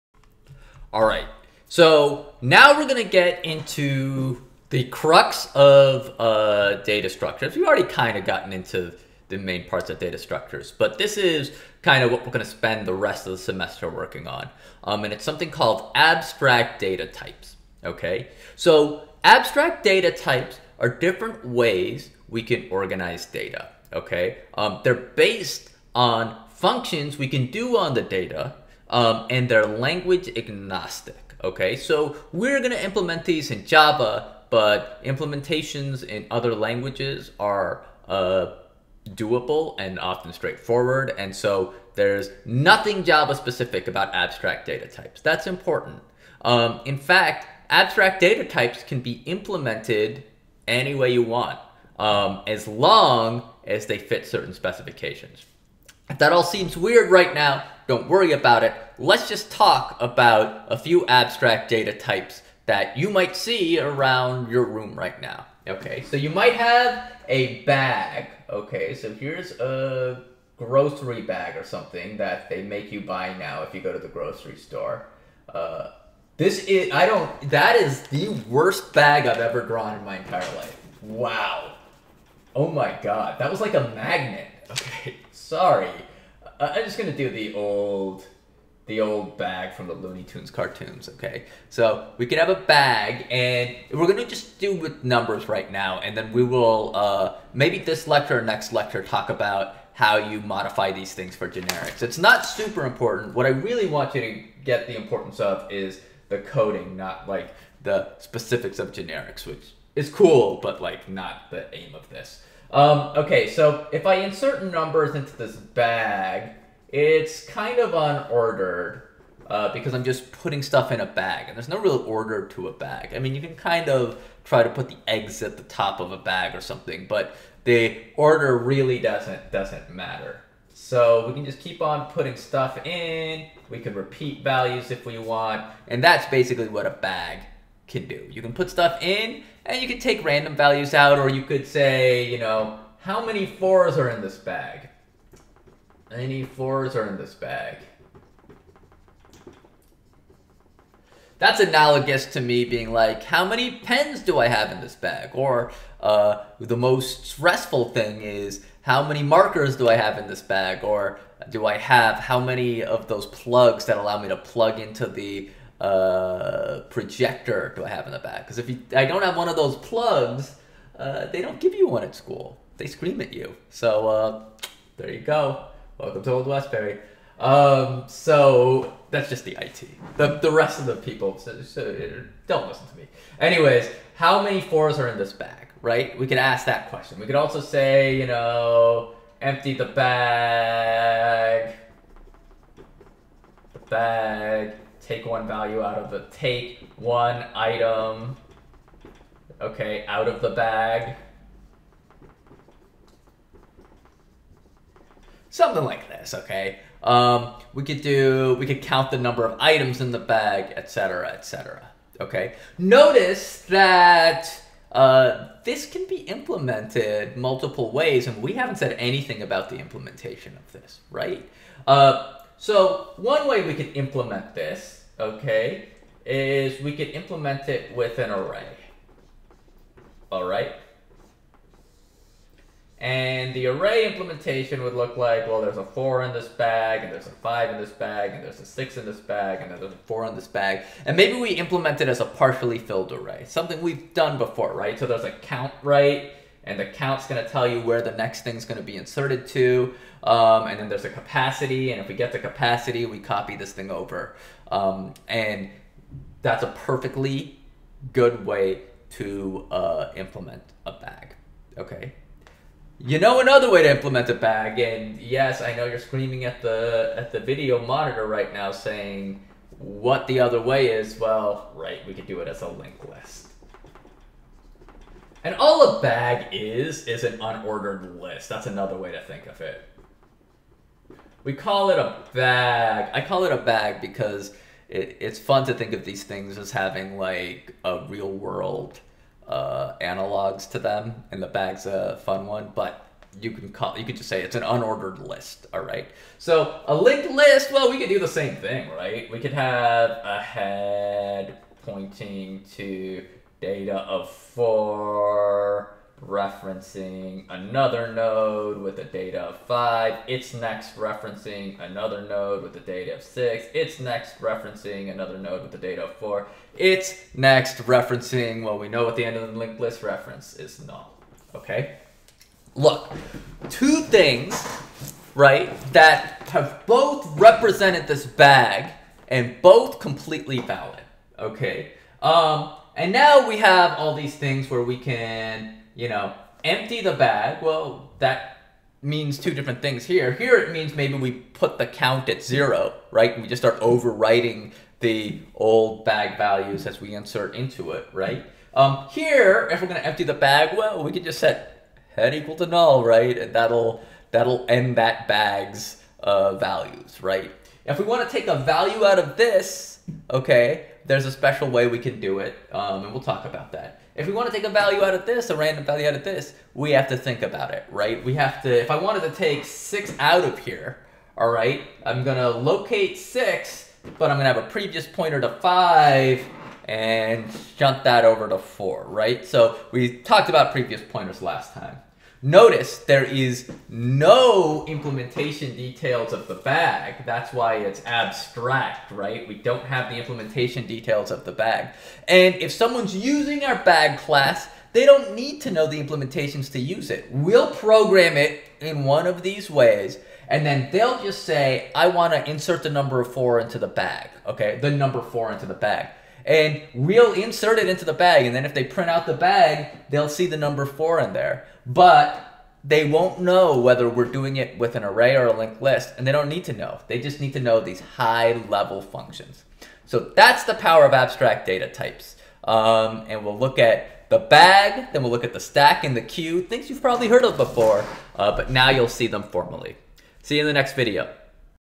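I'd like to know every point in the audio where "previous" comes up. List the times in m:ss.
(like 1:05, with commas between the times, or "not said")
6:14, 6:20.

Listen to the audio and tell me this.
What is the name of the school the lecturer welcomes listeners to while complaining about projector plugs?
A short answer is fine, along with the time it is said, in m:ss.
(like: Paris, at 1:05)
Old Westbury, at 2:56.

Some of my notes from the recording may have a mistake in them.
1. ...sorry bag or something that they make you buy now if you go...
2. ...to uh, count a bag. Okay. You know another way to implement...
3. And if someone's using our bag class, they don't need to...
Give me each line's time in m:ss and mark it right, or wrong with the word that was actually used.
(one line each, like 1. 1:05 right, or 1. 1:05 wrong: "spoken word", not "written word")
1. 1:10 wrong: "grocery", not "sorry"
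2. 4:19 wrong: "implement", not "count"
3. 6:32 right.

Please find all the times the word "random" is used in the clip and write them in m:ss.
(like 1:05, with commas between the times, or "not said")
2:20, 6:05.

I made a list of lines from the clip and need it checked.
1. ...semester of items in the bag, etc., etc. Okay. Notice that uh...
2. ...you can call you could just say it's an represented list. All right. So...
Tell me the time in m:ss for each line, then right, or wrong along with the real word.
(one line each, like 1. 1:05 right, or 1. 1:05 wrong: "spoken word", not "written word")
1. 3:29 wrong: "number", not "semester"
2. 4:53 wrong: "unordered", not "represented".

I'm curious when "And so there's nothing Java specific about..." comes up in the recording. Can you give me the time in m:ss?
0:41.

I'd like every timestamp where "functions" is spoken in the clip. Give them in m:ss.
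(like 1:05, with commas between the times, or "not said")
0:26, 6:59.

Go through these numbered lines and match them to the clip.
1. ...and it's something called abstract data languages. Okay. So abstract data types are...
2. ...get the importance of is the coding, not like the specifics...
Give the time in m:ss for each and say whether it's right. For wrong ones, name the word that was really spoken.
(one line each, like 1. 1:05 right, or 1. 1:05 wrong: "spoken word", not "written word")
1. 0:15 wrong: "types", not "languages"
2. 1:44 right.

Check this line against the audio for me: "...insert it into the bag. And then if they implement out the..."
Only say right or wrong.
wrong.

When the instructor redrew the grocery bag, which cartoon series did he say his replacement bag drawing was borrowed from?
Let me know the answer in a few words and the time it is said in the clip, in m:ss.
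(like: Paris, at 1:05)
Looney Tunes, at 1:29.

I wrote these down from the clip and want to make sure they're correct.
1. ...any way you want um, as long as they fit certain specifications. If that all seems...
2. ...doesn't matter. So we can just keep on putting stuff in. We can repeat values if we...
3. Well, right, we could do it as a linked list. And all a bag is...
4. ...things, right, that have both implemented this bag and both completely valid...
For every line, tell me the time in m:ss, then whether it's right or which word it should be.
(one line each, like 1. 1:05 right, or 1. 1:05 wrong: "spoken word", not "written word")
1. 0:50 right
2. 2:09 right
3. 4:31 right
4. 5:24 wrong: "represented", not "implemented".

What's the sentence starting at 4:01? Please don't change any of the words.
And maybe we implement it as a partially filled array, something we've done before, right?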